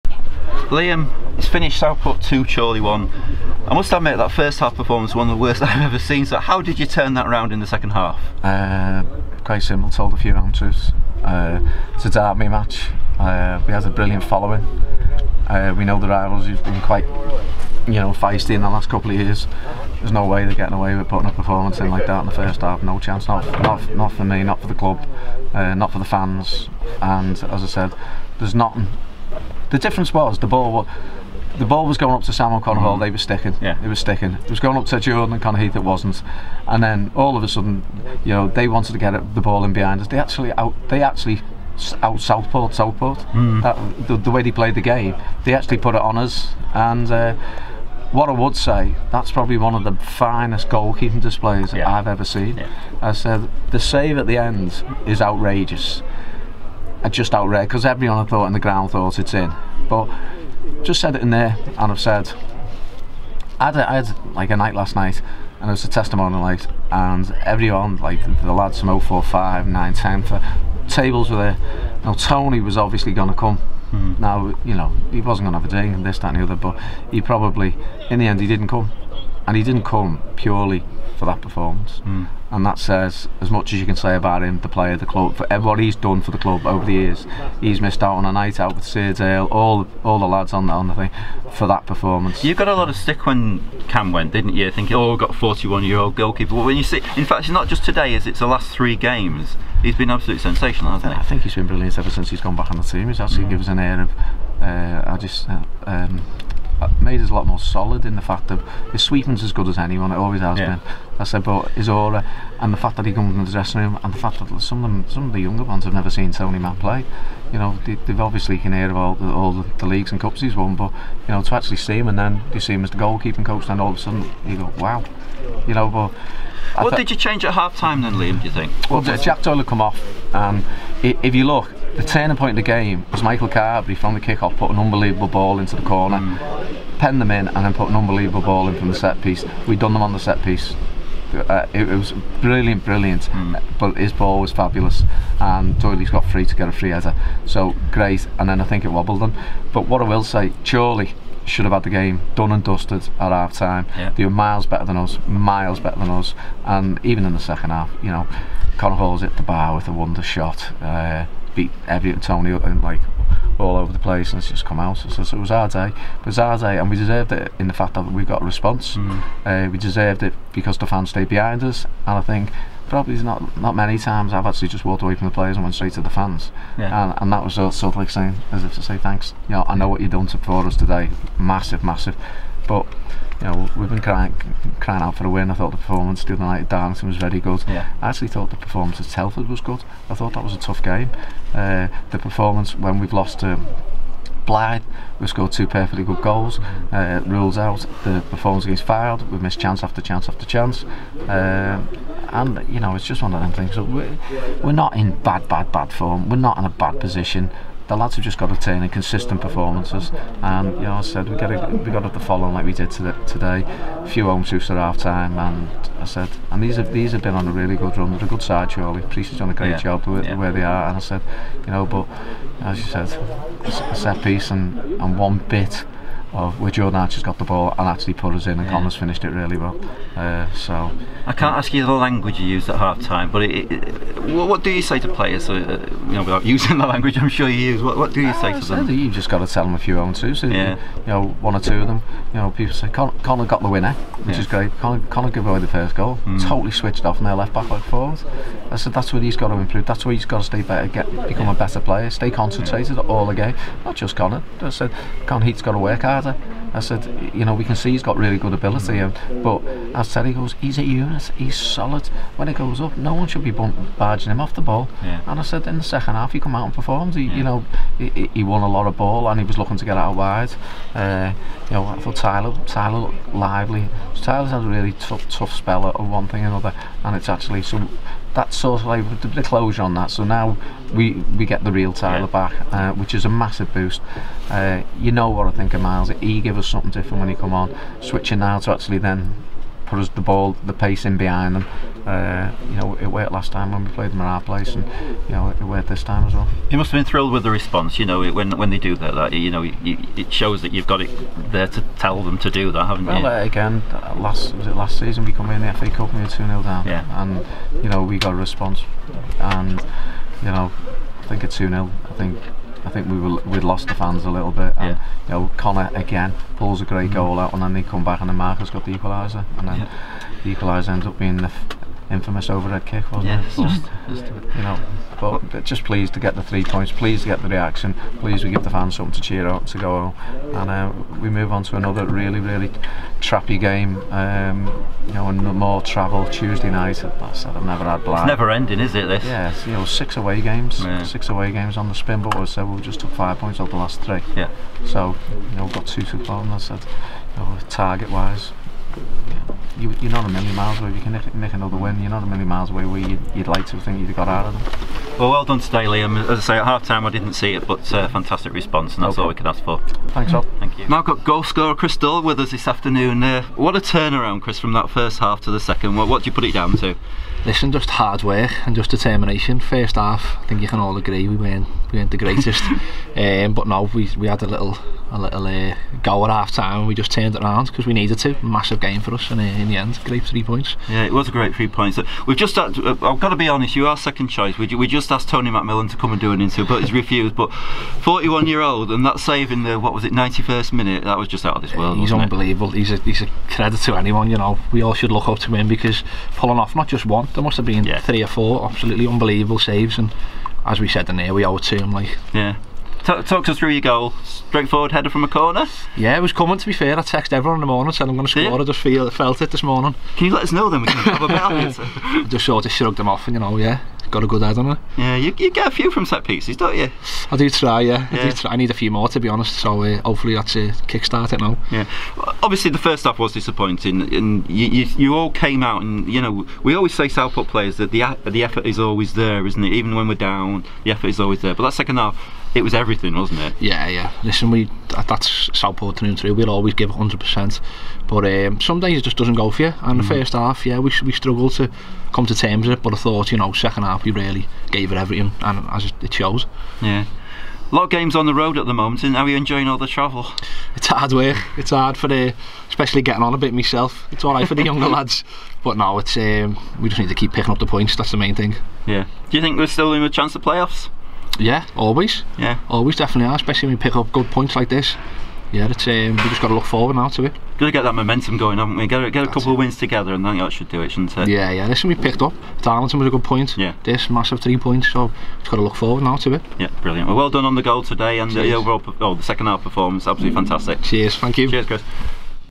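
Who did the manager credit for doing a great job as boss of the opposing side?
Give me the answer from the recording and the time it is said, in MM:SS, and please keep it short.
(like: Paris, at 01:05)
Preece, at 03:39.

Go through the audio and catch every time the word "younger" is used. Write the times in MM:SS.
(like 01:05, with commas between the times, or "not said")
01:55, 07:34.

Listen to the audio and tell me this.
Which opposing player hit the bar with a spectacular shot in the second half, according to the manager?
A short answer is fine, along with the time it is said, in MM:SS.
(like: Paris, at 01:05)
Connor Hall, at 02:38.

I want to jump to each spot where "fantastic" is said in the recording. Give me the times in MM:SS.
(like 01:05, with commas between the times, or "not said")
05:58, 08:00.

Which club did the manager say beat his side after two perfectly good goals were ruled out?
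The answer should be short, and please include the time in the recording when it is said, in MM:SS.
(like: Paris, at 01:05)
Blyth, at 03:14.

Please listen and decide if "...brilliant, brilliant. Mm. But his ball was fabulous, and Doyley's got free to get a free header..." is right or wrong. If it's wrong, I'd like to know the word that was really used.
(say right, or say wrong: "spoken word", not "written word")
right.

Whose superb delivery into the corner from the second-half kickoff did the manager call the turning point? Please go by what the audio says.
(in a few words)
Michael Carberry.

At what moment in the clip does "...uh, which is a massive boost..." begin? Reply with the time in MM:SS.
04:42.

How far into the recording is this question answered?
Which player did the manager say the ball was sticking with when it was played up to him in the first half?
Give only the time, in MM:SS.
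00:32.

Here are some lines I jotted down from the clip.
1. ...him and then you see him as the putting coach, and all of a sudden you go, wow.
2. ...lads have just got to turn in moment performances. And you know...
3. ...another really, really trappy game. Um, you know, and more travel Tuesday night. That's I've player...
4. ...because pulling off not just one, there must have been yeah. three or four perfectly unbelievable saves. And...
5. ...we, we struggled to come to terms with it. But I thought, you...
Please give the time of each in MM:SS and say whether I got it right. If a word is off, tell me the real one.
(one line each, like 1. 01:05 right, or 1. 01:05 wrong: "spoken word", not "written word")
1. 02:01 wrong: "goalkeeping", not "putting"
2. 03:27 wrong: "consistent", not "moment"
3. 05:31 wrong: "never", not "player"
4. 06:35 wrong: "absolutely", not "perfectly"
5. 07:20 right.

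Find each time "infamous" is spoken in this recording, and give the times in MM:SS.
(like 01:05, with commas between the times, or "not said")
05:22.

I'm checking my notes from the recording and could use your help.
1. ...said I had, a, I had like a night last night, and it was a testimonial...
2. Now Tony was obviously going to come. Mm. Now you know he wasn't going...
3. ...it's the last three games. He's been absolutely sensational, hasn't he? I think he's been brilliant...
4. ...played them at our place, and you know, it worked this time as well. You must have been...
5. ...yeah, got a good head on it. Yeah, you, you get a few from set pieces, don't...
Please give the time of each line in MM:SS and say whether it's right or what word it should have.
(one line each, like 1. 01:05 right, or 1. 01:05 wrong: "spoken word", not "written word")
1. 01:01 right
2. 01:12 right
3. 01:38 right
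4. 04:53 right
5. 06:53 right.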